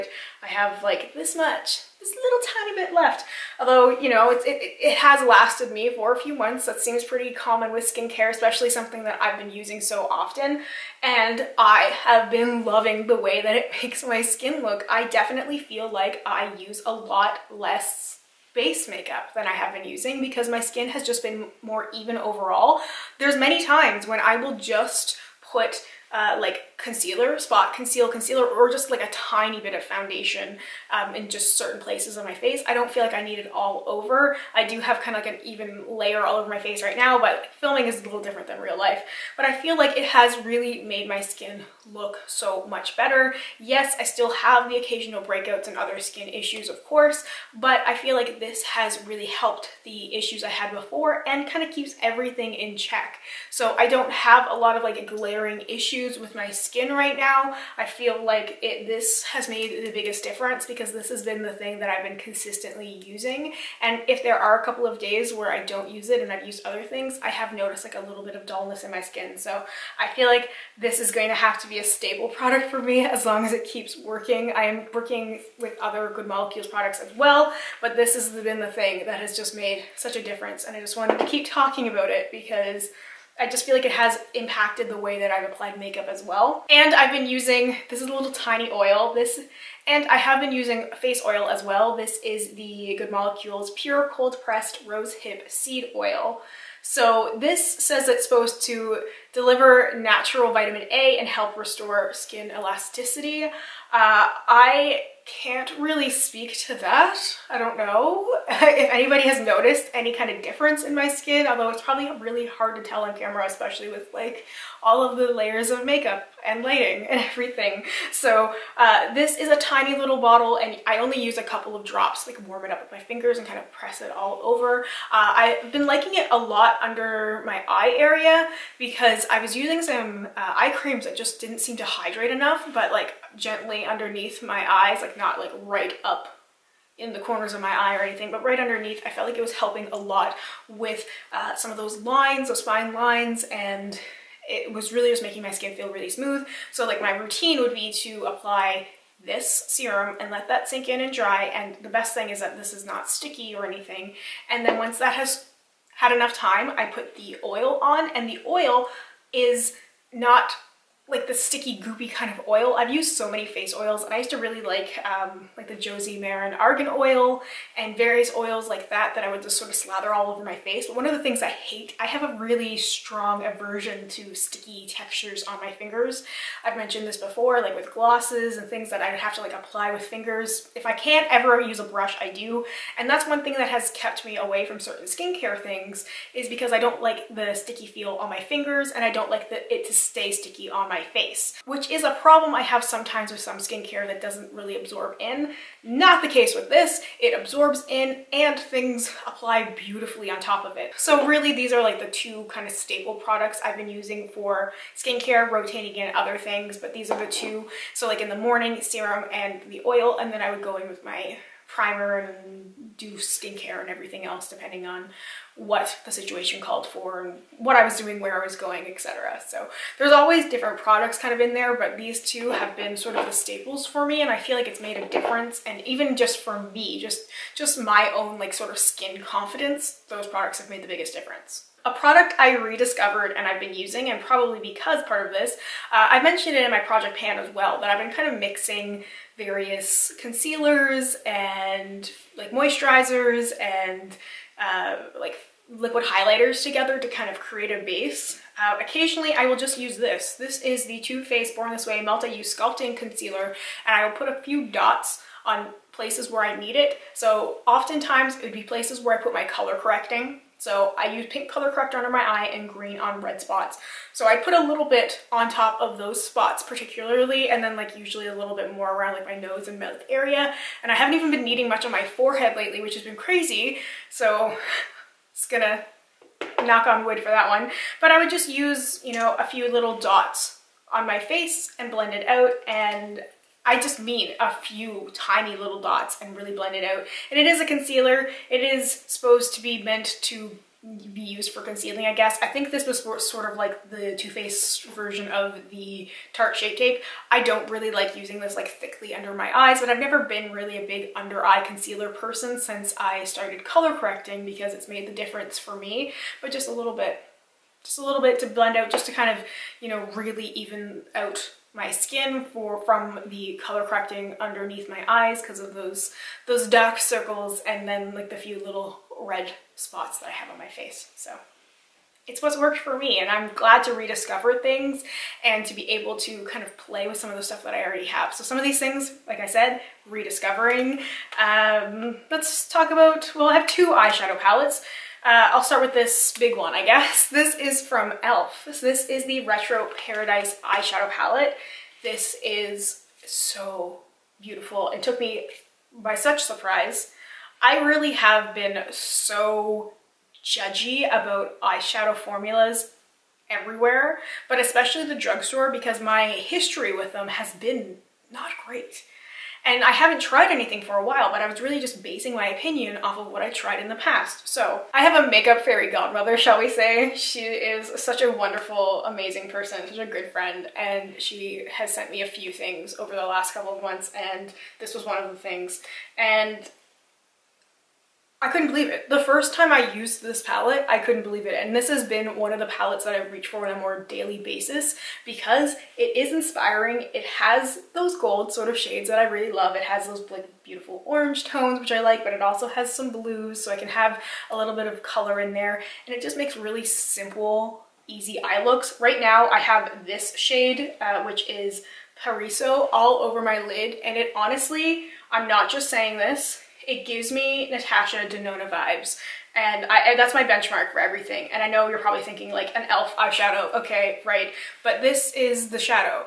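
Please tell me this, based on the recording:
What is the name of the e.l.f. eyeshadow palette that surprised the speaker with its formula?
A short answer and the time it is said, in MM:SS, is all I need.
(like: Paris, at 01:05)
Retro Paradise, at 05:39.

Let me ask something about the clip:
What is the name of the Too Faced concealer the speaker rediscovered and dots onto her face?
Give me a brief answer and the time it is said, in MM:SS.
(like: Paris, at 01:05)
Born This Way Multi-Use Sculpting Concealer, at 04:11.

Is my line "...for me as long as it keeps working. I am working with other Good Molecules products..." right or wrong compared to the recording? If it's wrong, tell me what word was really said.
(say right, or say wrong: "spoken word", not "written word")
right.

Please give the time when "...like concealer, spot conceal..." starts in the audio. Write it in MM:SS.
00:26.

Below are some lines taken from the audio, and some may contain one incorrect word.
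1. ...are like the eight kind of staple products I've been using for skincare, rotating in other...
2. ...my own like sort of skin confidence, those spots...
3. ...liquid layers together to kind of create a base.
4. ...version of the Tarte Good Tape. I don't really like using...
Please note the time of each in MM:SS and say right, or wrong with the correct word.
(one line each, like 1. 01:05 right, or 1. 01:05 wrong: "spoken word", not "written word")
1. 03:21 wrong: "two", not "eight"
2. 03:47 wrong: "products", not "spots"
3. 04:05 wrong: "highlighters", not "layers"
4. 04:54 wrong: "Shape", not "Good".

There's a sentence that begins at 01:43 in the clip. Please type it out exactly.
Uh, I can't really speak to that.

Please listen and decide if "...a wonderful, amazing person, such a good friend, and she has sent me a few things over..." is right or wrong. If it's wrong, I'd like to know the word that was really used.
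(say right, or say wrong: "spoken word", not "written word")
right.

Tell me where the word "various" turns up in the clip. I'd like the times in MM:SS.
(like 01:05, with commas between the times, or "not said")
02:47, 03:59.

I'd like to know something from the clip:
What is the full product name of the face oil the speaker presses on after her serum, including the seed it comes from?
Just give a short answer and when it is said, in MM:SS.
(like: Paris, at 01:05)
Pure Cold Pressed Rose Hip Seed Oil, at 01:33.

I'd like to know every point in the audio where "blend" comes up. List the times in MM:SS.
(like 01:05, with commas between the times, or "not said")
04:41, 04:46, 05:08.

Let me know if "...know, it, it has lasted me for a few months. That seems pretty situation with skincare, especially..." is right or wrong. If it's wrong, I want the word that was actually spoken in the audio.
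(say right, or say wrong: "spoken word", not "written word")
wrong: "common", not "situation".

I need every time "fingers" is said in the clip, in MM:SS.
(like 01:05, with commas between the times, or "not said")
02:03, 02:55, 03:00, 03:08.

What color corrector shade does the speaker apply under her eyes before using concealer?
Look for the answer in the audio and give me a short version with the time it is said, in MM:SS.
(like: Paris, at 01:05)
pink, at 04:21.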